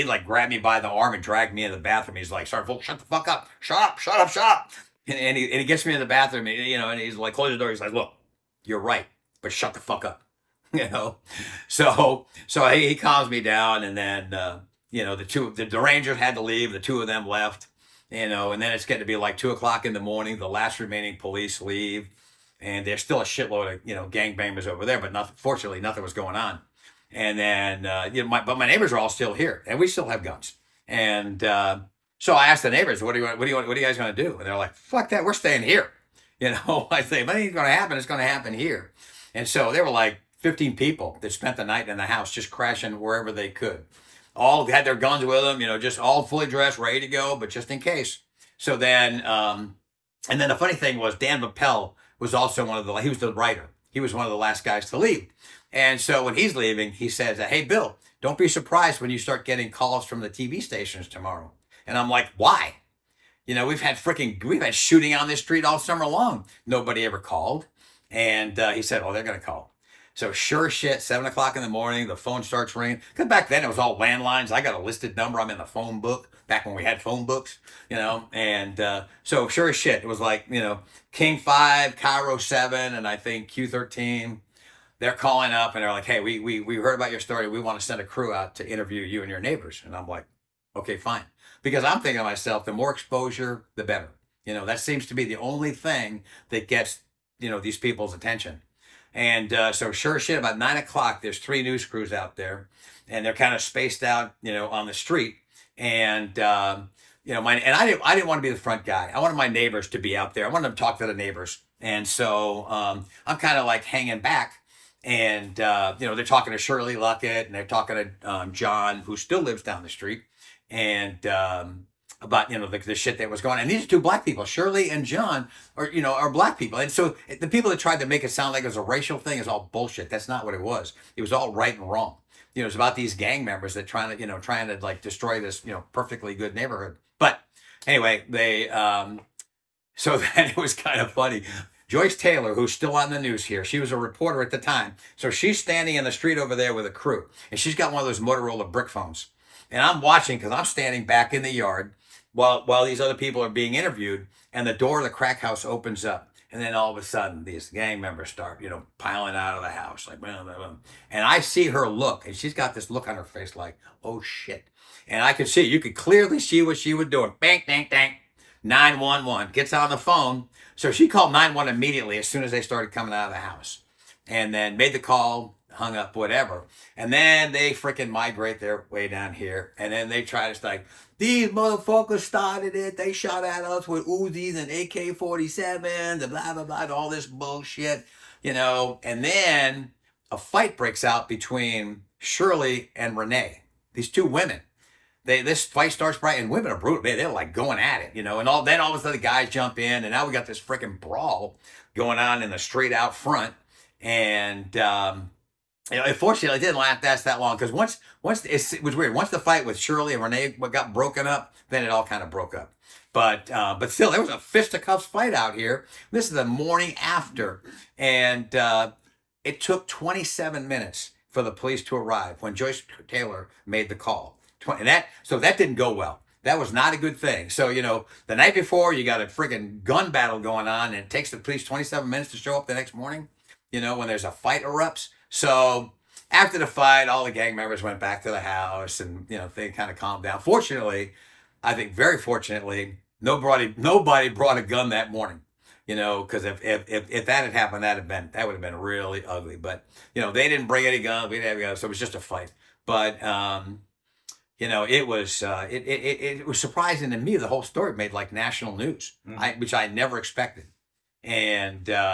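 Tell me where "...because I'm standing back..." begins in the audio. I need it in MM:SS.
02:30.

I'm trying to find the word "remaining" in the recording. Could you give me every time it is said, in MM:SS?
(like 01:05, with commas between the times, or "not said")
00:20.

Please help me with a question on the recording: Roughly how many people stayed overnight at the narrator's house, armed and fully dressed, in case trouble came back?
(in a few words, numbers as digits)
15.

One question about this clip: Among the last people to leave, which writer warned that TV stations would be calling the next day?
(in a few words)
Dan Mappel.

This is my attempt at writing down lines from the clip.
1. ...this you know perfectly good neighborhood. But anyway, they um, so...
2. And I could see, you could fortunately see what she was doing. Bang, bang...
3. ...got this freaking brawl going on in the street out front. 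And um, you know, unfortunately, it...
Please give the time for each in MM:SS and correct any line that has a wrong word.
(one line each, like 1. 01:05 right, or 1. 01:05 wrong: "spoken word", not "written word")
1. 02:15 right
2. 02:45 wrong: "clearly", not "fortunately"
3. 03:20 right.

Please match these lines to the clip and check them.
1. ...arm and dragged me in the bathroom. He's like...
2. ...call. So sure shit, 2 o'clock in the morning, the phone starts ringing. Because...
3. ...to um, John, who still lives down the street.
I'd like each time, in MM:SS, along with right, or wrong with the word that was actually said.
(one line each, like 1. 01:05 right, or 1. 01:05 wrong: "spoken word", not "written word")
1. 00:00 right
2. 01:09 wrong: "7", not "2"
3. 01:57 right.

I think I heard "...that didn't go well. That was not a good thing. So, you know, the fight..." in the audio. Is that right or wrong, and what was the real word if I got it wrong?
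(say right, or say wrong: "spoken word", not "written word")
wrong: "night", not "fight".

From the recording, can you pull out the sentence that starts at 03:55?
So after the fight, all the gang members went back to the house and, you know, they kind of calmed down.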